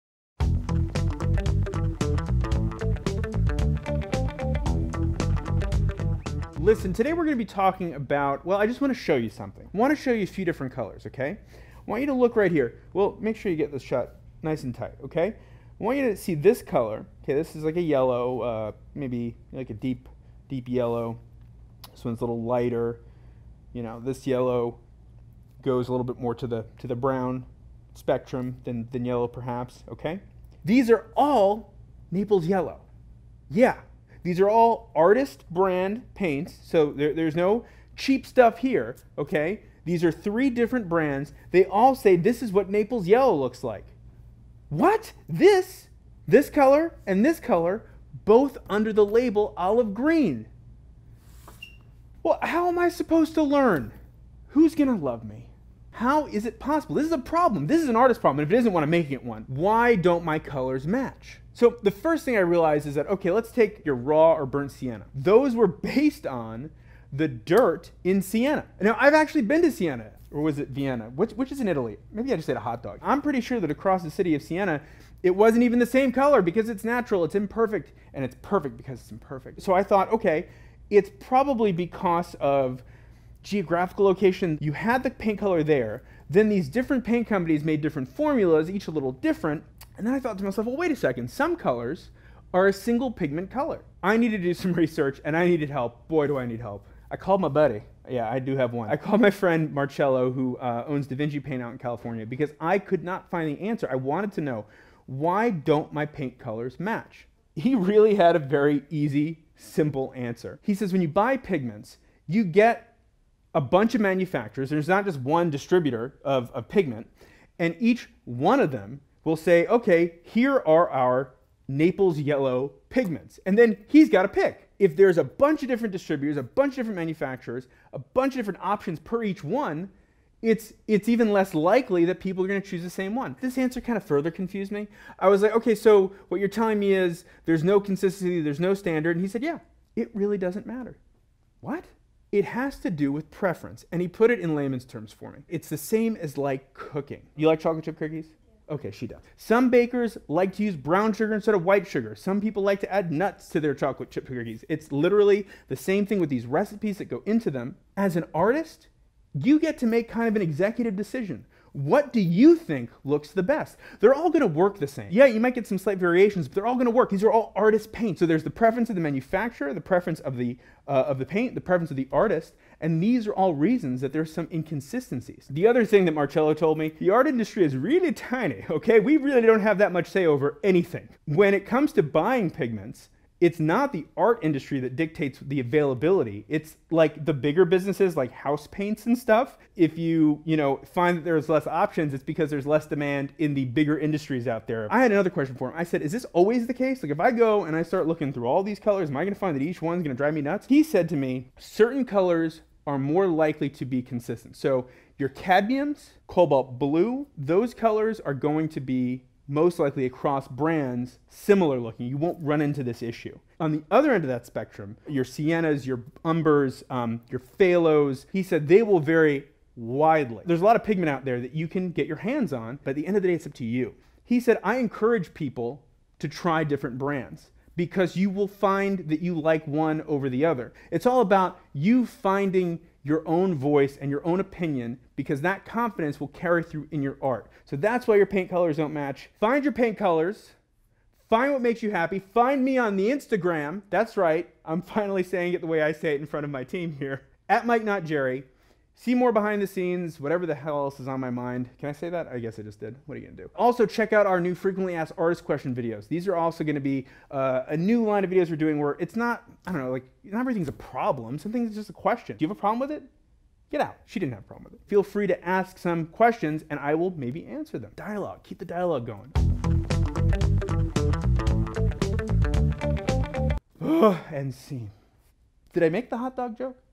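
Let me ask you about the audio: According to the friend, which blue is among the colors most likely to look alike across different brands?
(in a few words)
Cobalt blue.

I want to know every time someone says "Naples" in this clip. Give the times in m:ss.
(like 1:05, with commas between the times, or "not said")
0:32, 0:42, 2:01.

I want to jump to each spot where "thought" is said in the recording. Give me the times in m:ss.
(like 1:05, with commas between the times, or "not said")
1:19, 1:30.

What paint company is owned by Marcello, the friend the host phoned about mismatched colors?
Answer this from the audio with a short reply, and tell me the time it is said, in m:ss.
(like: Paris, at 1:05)
Da Vinci Paint, at 1:41.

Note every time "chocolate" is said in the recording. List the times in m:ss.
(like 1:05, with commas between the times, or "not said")
2:27, 2:33.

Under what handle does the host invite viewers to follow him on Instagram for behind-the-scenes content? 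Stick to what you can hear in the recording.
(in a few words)
Mike Not Jerry.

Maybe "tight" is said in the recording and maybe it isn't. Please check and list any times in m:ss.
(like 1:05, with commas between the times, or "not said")
0:14.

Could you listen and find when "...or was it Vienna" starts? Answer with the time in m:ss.
1:10.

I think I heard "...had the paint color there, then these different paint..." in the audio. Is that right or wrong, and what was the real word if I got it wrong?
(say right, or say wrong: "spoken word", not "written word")
right.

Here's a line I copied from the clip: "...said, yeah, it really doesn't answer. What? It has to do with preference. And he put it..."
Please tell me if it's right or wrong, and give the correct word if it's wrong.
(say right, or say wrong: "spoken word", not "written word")
wrong: "matter", not "answer".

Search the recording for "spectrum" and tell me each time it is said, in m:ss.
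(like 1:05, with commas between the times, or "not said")
0:27, 3:34.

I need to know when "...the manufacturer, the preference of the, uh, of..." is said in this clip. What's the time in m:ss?
2:48.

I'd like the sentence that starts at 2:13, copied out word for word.
This answer kind of further confused me.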